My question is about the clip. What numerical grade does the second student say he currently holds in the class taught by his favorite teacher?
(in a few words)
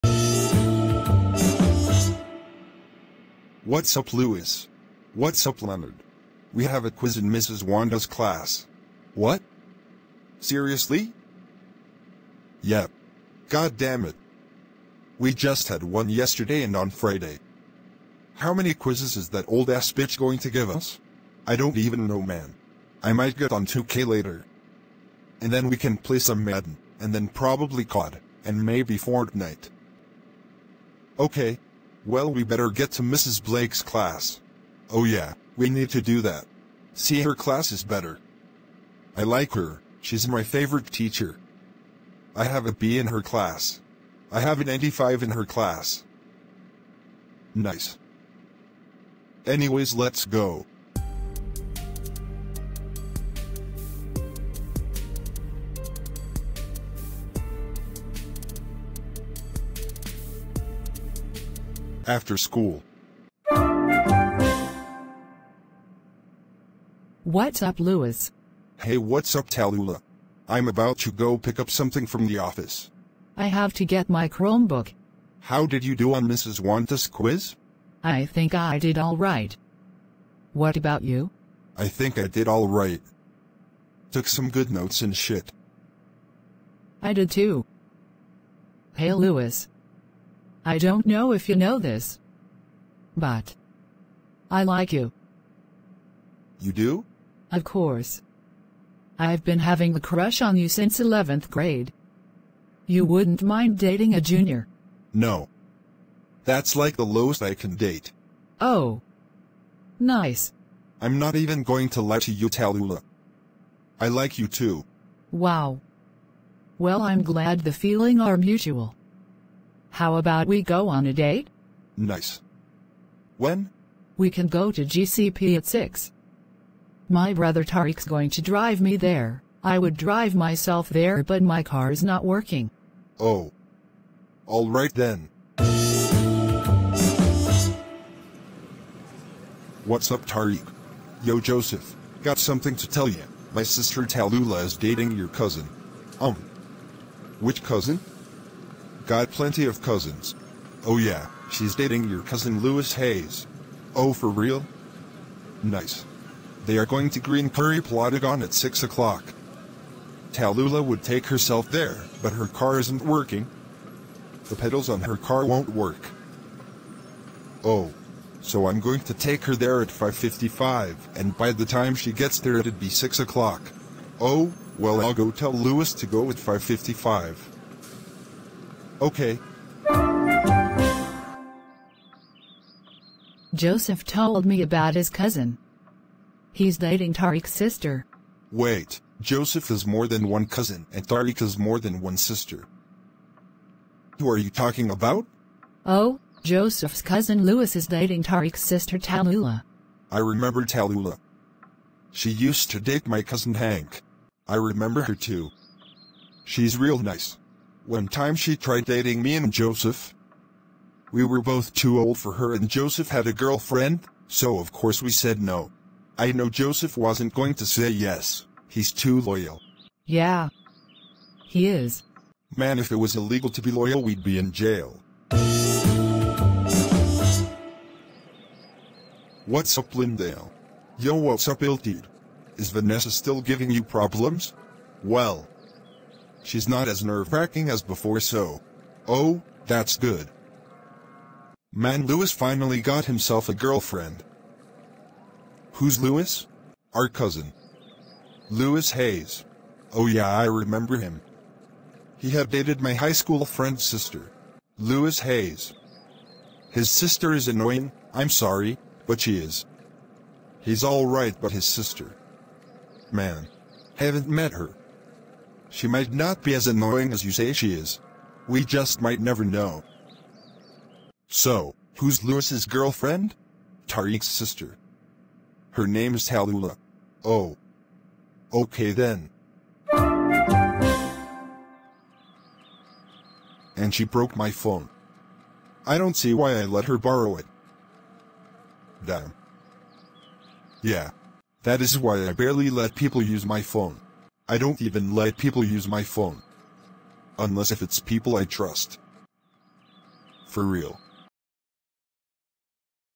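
85.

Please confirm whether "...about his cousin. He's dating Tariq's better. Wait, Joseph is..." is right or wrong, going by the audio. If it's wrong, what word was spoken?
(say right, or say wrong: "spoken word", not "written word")
wrong: "sister", not "better".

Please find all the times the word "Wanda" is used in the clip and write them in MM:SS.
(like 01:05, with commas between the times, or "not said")
00:07, 01:16.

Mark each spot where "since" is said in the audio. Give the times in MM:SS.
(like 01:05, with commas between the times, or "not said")
01:40.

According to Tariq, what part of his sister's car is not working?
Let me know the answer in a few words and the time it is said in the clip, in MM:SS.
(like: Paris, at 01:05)
The pedals, at 02:44.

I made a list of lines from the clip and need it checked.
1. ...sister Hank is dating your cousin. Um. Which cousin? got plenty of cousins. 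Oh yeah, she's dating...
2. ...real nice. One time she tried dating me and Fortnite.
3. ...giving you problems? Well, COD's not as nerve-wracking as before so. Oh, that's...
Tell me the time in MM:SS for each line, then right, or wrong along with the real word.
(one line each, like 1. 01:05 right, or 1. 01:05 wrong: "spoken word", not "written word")
1. 02:23 wrong: "Talula", not "Hank"
2. 03:26 wrong: "Joseph", not "Fortnite"
3. 03:53 wrong: "She", not "COD".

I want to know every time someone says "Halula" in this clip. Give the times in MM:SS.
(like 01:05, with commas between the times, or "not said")
04:36.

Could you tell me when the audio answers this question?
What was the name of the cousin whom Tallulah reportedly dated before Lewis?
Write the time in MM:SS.
03:23.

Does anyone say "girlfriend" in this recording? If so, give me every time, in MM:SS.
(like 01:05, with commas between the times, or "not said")
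03:33, 04:03, 04:32.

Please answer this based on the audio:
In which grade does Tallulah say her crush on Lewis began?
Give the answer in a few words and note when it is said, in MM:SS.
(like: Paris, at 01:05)
11th grade, at 01:40.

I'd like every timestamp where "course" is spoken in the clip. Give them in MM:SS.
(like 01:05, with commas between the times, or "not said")
01:37, 03:34.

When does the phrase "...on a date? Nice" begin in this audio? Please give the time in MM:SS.
02:00.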